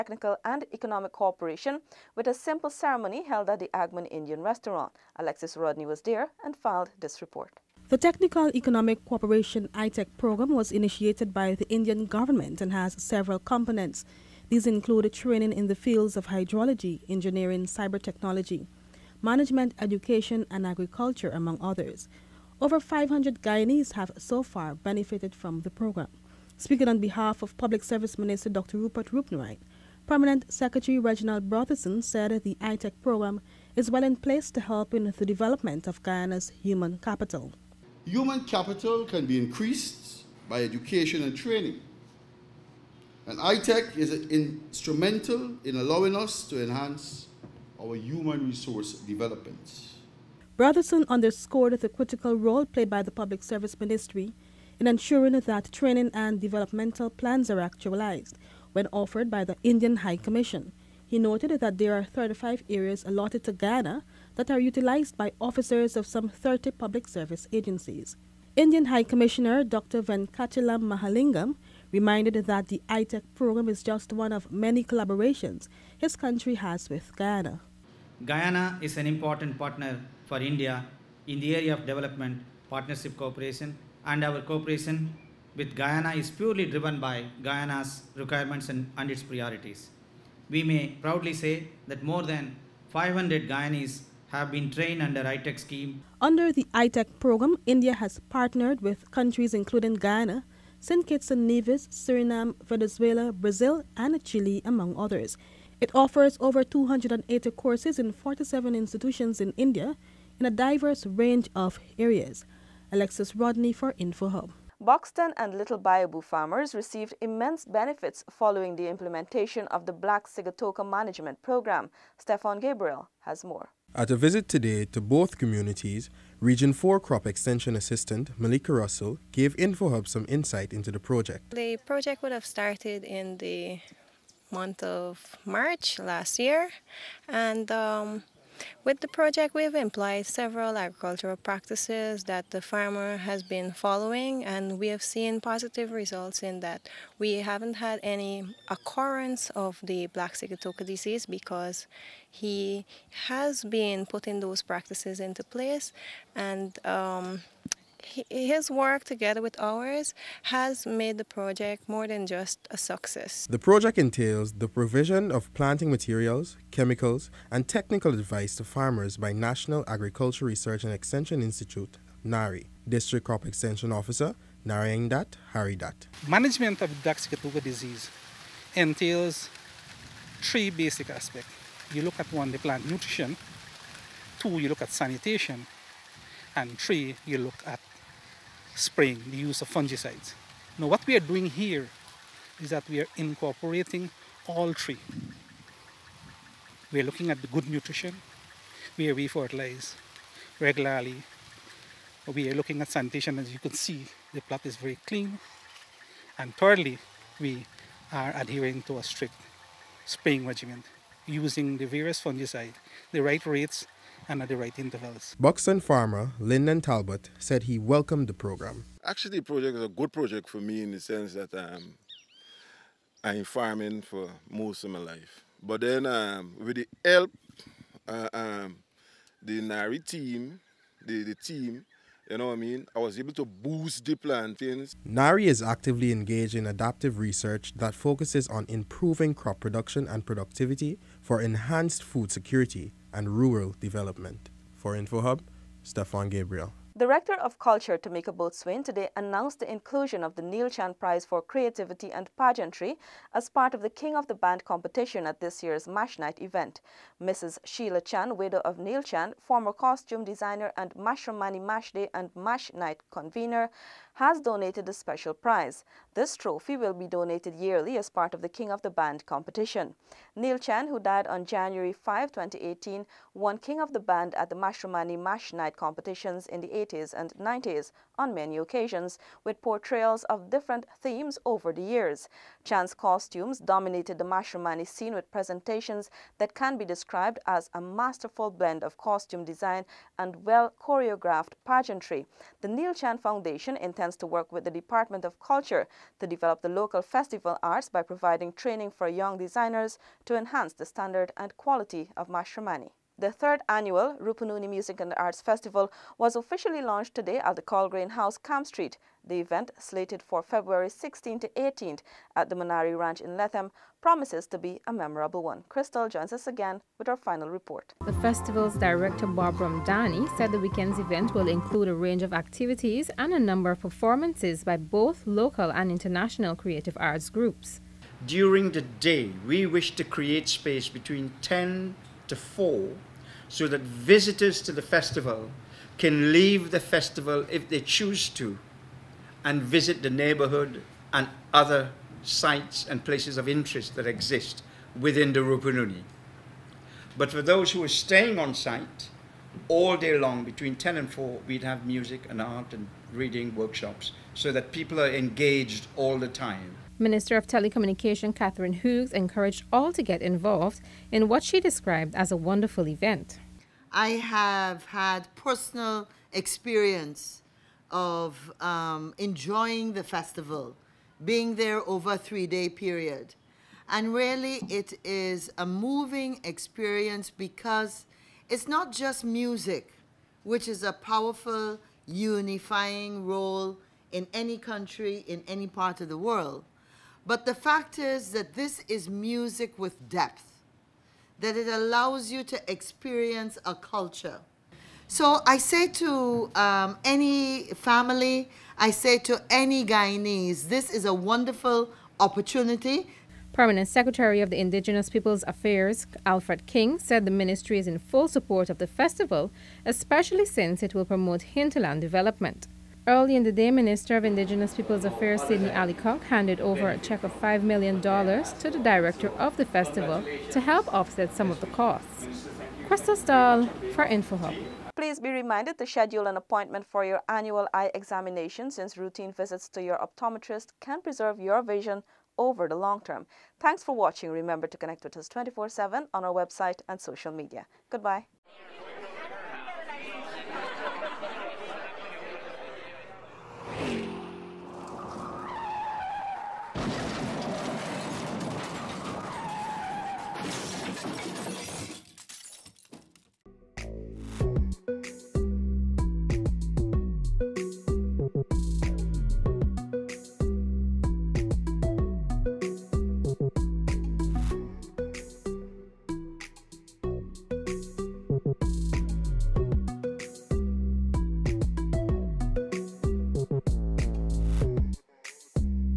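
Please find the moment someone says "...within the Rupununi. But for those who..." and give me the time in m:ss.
5:44.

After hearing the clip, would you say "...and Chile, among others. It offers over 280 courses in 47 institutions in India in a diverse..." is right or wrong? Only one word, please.
right.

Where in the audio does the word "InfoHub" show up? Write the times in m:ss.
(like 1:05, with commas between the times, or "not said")
1:53, 2:09, 4:04, 7:04.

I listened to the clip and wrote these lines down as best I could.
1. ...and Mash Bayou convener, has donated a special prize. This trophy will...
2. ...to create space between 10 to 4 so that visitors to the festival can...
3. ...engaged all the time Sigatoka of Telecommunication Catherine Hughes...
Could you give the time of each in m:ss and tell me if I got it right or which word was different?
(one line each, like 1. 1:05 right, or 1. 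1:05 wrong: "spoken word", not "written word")
1. 4:22 wrong: "Night", not "Bayou"
2. 5:29 right
3. 5:55 wrong: "Minister", not "Sigatoka".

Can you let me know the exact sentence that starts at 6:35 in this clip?
So I say to um, any family, I say to any Guyanese, this is a wonderful opportunity.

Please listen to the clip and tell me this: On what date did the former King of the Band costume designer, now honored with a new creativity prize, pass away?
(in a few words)
January 5, 2018.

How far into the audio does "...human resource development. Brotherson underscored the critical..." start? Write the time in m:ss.
0:47.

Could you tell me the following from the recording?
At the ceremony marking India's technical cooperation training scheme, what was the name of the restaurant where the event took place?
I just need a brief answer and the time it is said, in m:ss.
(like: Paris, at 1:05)
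Agman Indian restaurant, at 0:03.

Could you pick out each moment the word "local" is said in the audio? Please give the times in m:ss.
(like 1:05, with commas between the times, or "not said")
4:56, 5:25.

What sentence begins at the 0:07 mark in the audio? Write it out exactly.
The Technical Economic Cooperation ITEC program was initiated by the Indian government and has several components.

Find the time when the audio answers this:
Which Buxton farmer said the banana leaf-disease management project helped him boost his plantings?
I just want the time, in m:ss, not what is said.
3:36.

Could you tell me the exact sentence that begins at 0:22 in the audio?
Over 500 Guyanese have so far benefited from the program.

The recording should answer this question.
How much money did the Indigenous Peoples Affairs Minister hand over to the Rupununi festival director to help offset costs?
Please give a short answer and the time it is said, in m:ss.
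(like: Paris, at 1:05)
$5 million, at 6:57.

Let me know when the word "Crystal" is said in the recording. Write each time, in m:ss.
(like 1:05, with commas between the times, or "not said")
5:15, 7:02.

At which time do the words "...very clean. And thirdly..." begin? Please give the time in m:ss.
3:24.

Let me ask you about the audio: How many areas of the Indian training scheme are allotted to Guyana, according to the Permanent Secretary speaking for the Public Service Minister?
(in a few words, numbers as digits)
35.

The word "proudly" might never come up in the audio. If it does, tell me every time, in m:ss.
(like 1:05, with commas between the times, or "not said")
1:31.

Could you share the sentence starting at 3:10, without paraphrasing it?
Now what we are doing here is that we are incorporating all three.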